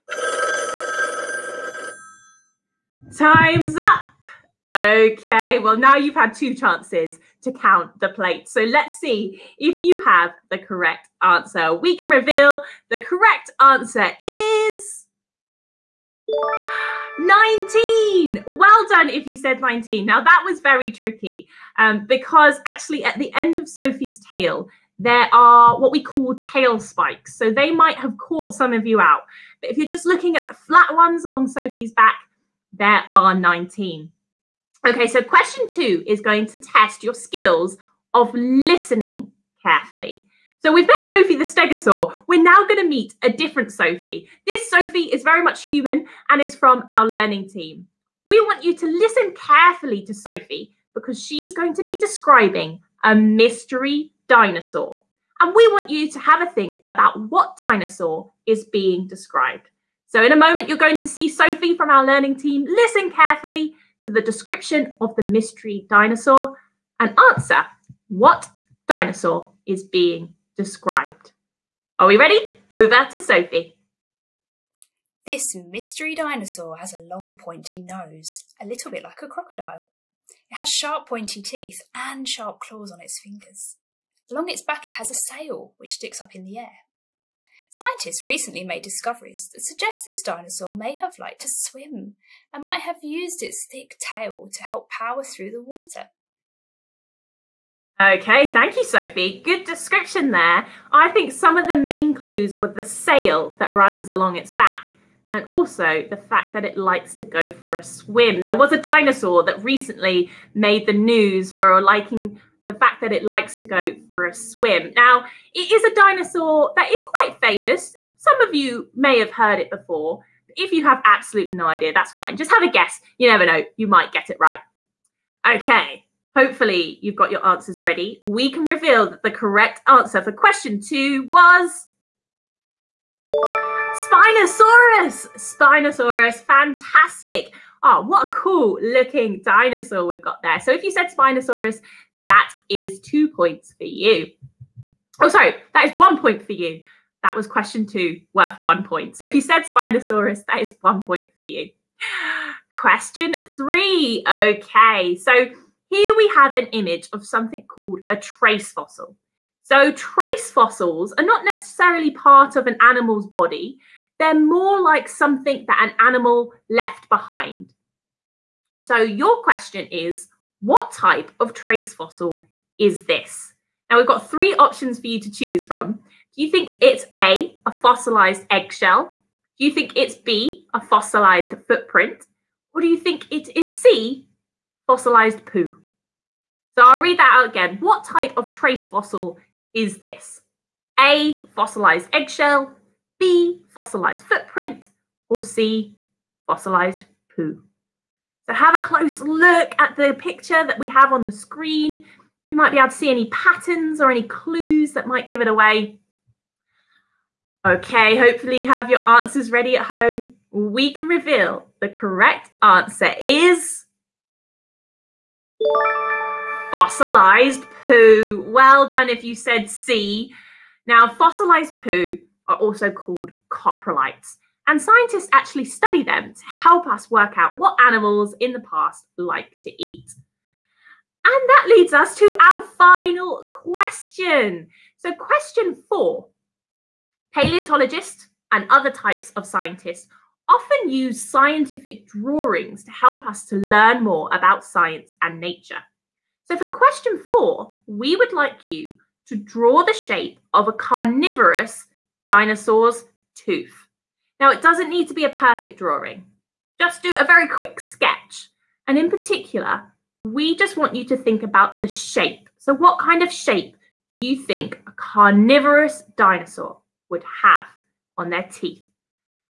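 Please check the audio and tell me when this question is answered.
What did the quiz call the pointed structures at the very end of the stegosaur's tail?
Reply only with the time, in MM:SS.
00:26.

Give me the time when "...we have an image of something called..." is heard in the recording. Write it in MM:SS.
02:36.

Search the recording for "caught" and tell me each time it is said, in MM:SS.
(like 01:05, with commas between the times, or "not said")
00:28.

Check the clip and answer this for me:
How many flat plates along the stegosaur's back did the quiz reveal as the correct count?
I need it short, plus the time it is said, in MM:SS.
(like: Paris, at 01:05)
19, at 00:17.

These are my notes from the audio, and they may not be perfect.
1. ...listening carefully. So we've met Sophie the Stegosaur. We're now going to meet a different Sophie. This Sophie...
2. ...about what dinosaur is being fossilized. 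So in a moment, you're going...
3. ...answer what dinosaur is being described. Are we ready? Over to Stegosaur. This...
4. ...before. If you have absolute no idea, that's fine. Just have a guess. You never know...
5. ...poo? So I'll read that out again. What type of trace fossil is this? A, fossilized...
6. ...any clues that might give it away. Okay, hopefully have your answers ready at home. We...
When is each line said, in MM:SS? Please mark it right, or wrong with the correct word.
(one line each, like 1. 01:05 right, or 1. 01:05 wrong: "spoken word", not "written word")
1. 00:38 right
2. 00:56 wrong: "described", not "fossilized"
3. 01:07 wrong: "Sophie", not "Stegosaur"
4. 01:59 right
5. 03:05 right
6. 03:24 right.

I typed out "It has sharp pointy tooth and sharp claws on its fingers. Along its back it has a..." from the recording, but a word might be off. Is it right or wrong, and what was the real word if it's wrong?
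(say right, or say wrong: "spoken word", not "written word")
wrong: "teeth", not "tooth".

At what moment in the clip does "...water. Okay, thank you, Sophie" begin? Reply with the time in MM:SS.
01:35.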